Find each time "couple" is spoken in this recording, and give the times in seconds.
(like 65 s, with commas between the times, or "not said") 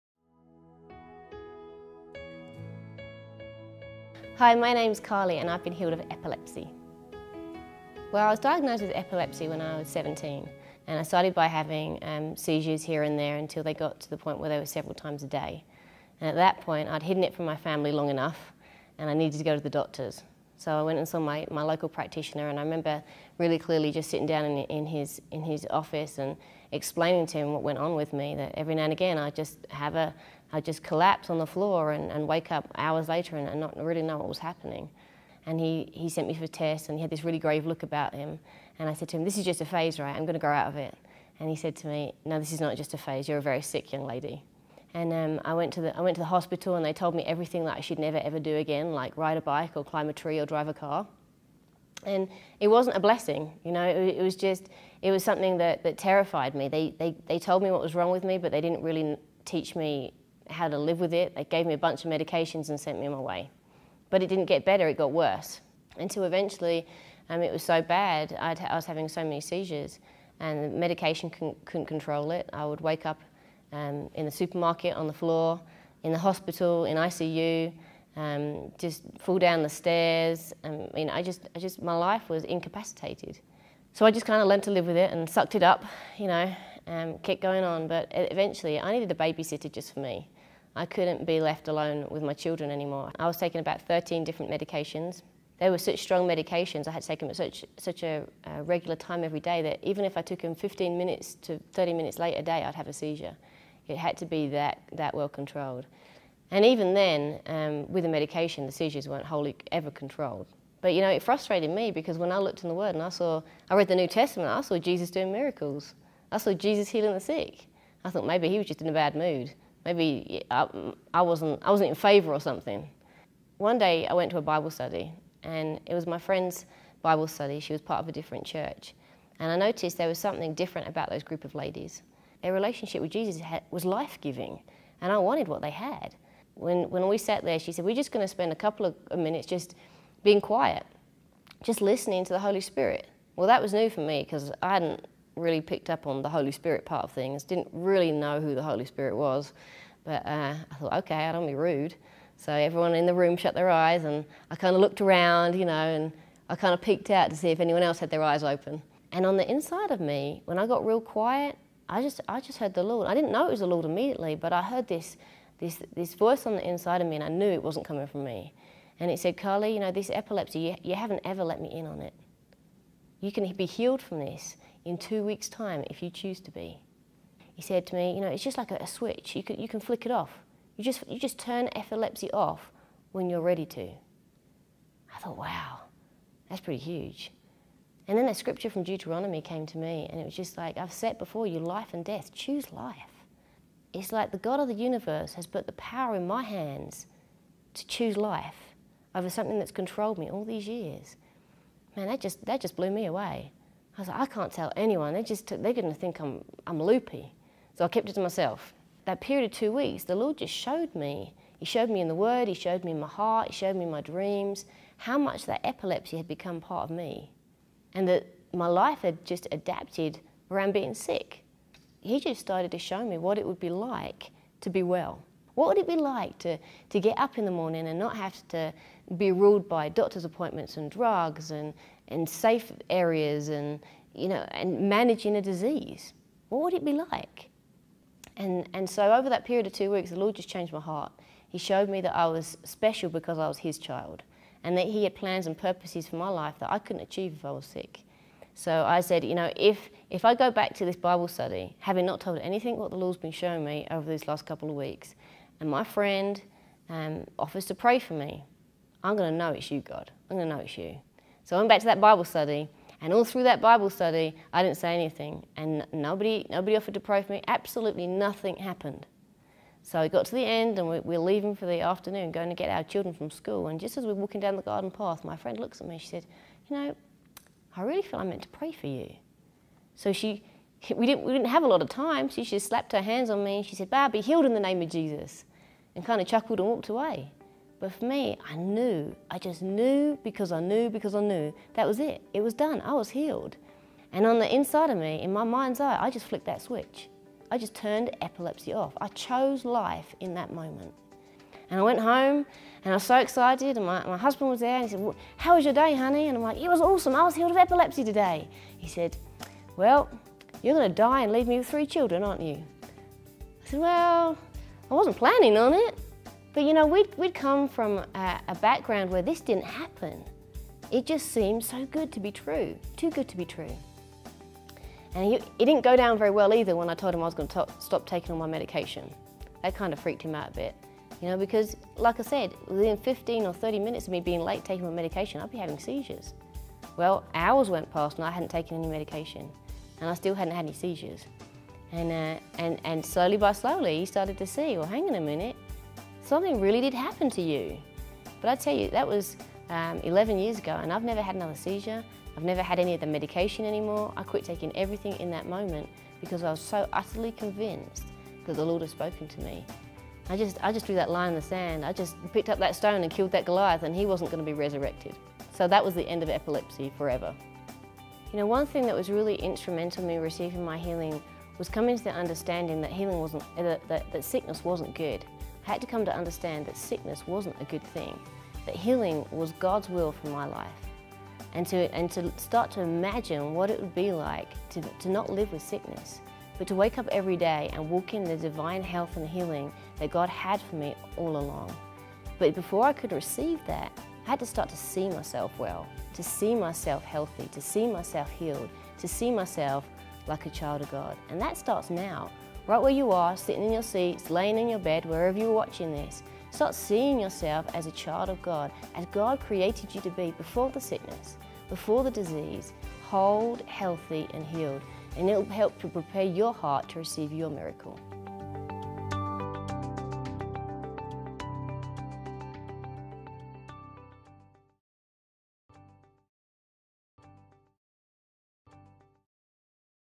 138 s, 254 s.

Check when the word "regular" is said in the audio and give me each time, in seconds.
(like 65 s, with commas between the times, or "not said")
98 s.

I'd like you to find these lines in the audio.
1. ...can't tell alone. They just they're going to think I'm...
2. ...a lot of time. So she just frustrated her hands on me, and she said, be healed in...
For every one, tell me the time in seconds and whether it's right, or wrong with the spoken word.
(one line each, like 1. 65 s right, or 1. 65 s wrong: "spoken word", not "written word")
1. 204 s wrong: "anyone", not "alone"
2. 281 s wrong: "slapped", not "frustrated".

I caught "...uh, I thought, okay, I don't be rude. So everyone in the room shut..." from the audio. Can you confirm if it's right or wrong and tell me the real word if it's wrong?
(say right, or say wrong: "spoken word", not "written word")
right.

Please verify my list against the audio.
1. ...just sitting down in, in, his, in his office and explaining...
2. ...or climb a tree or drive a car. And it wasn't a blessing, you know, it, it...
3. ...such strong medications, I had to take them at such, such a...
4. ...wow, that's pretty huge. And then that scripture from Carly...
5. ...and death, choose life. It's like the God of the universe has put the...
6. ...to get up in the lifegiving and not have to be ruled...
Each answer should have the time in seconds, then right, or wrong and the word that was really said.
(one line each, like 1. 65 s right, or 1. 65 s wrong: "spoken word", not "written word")
1. 23 s right
2. 49 s right
3. 95 s right
4. 185 s wrong: "Deuteronomy", not "Carly"
5. 191 s right
6. 226 s wrong: "morning", not "lifegiving".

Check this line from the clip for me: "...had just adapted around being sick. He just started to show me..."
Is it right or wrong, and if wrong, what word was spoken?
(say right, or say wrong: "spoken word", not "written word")
right.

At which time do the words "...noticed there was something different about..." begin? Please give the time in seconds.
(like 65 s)
129 s.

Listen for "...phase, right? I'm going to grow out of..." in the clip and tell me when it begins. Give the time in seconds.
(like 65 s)
39 s.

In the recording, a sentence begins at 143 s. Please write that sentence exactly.
Well, that was new for me because I hadn't really picked up on the Holy Spirit part of things.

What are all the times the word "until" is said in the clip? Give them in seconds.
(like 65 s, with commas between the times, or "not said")
13 s, 65 s.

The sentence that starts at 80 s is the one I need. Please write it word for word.
I um, mean, I just, I just, my life was incapacitated.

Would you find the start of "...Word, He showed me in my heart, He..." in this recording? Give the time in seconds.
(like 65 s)
212 s.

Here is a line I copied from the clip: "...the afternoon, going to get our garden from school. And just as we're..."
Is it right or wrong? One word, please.
wrong.